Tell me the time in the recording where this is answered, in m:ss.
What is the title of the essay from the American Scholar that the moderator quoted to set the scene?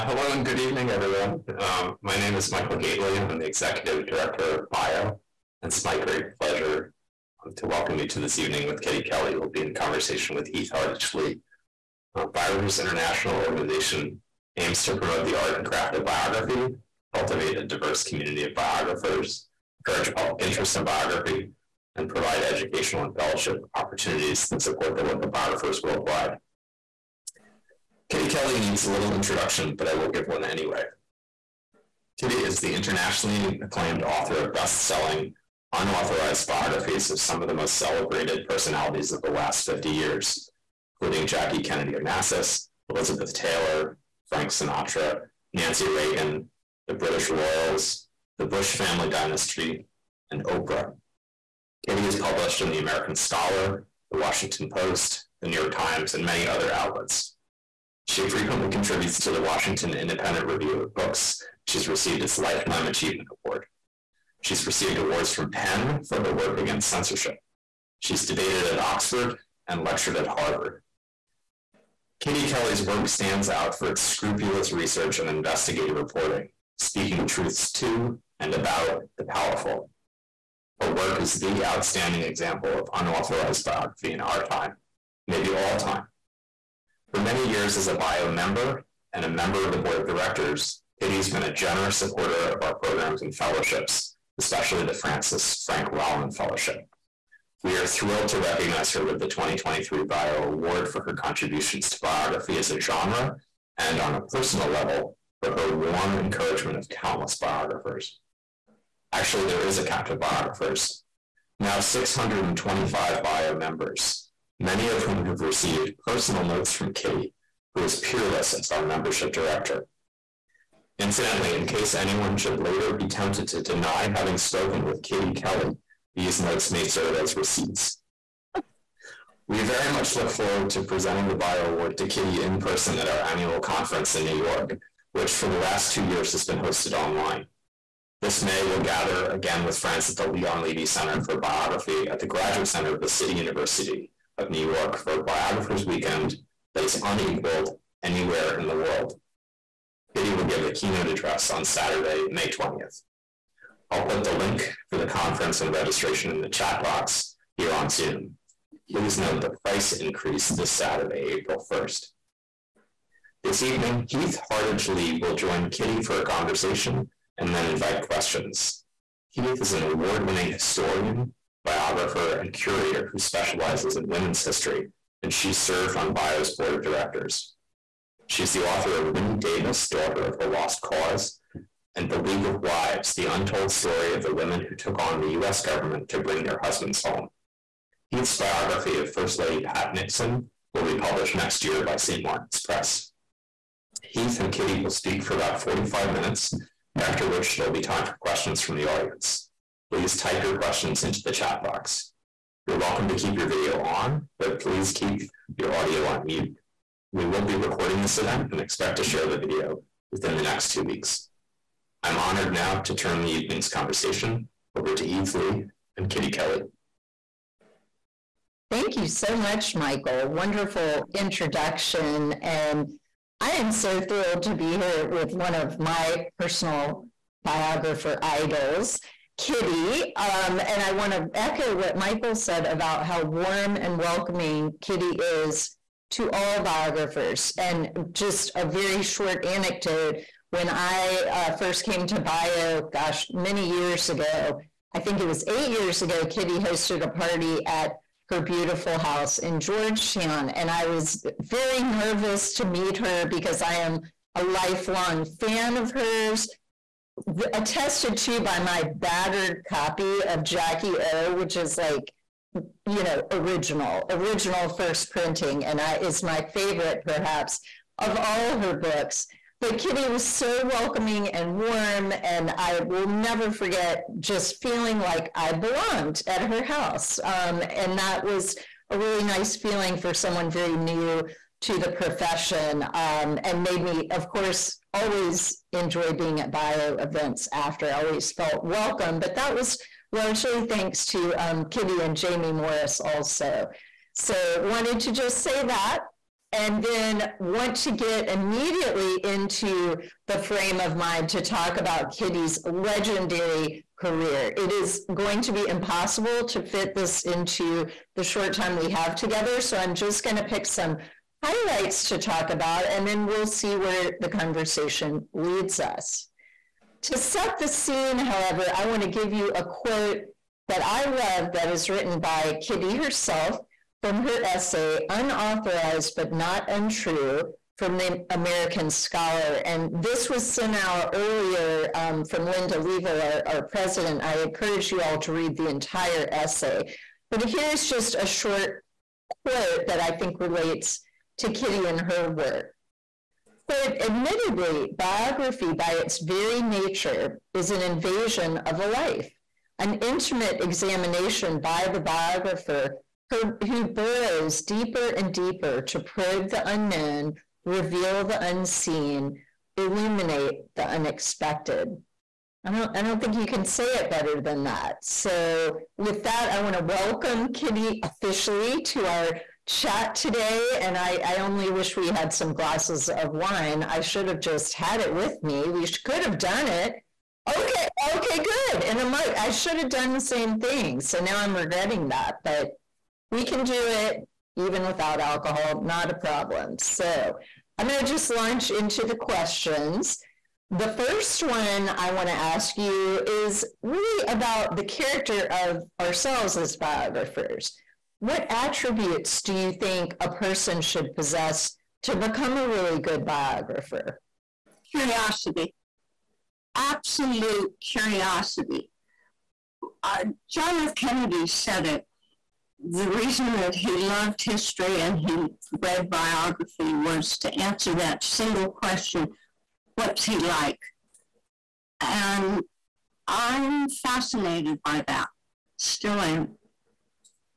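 5:25.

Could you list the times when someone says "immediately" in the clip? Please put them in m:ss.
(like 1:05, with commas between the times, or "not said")
4:58.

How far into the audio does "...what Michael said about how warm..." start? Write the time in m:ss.
3:51.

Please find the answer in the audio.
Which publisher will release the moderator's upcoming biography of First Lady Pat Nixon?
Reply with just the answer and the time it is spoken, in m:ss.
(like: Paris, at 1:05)
St. Martin's Press, at 3:11.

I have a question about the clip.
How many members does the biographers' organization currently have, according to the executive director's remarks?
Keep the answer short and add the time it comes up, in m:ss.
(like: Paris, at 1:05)
625, at 1:51.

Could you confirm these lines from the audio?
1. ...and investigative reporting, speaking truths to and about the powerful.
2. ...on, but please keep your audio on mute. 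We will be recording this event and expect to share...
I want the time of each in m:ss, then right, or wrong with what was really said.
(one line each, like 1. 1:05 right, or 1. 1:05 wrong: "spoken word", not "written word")
1. 1:15 right
2. 3:23 right.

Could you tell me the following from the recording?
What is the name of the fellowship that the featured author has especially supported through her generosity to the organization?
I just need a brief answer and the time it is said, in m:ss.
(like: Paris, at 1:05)
Frances Frank Rollin Fellowship, at 1:34.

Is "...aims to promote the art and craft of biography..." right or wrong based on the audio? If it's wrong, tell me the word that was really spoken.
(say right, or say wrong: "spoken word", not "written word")
right.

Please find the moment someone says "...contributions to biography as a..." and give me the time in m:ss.
1:41.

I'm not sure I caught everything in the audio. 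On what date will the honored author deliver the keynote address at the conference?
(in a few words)
May 20th.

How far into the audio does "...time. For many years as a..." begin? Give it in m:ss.
1:25.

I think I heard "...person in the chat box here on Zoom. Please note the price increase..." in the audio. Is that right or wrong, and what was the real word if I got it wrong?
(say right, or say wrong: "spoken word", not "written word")
wrong: "registration", not "person".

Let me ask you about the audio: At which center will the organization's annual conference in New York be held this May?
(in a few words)
Leon Levy Center for Biography.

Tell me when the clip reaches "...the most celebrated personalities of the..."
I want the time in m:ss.
0:37.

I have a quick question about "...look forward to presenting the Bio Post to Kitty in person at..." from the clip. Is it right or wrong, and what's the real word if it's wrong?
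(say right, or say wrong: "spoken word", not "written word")
wrong: "Award", not "Post".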